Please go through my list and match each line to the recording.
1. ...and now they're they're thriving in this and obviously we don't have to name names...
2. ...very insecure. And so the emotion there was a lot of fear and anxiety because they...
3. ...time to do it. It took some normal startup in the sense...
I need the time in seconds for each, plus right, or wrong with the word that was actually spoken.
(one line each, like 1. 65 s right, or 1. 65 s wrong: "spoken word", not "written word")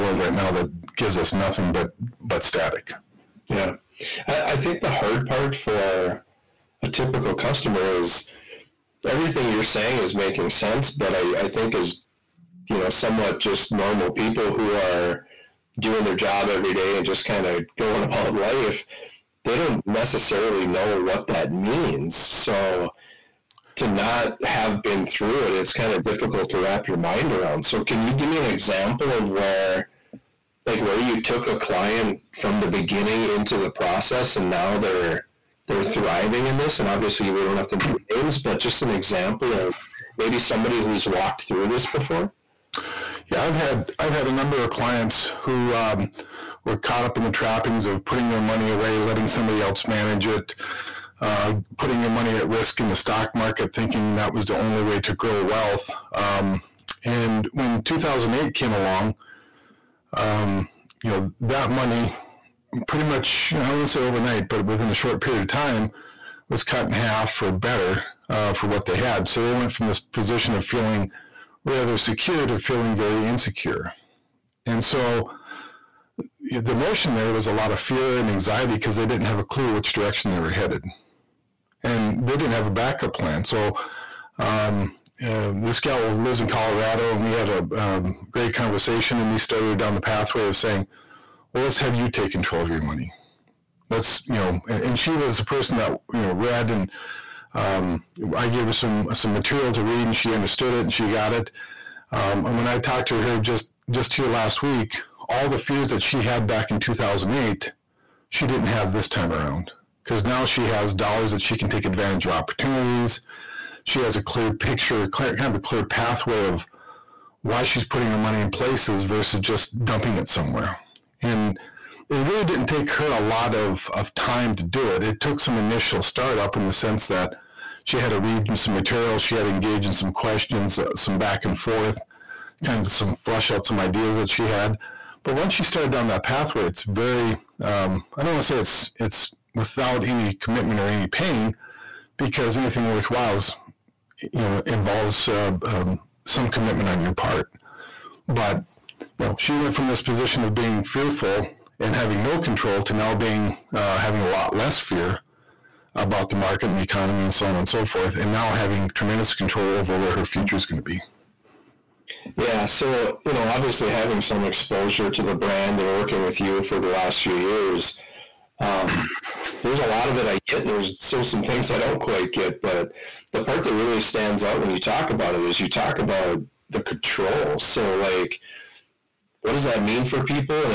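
1. 34 s right
2. 72 s right
3. 124 s wrong: "initial", not "normal".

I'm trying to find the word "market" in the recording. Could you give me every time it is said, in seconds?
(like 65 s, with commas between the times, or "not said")
53 s, 156 s.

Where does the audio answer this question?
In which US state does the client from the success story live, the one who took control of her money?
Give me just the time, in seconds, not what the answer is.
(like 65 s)
86 s.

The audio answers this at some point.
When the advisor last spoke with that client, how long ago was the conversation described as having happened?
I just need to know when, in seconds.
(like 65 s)
104 s.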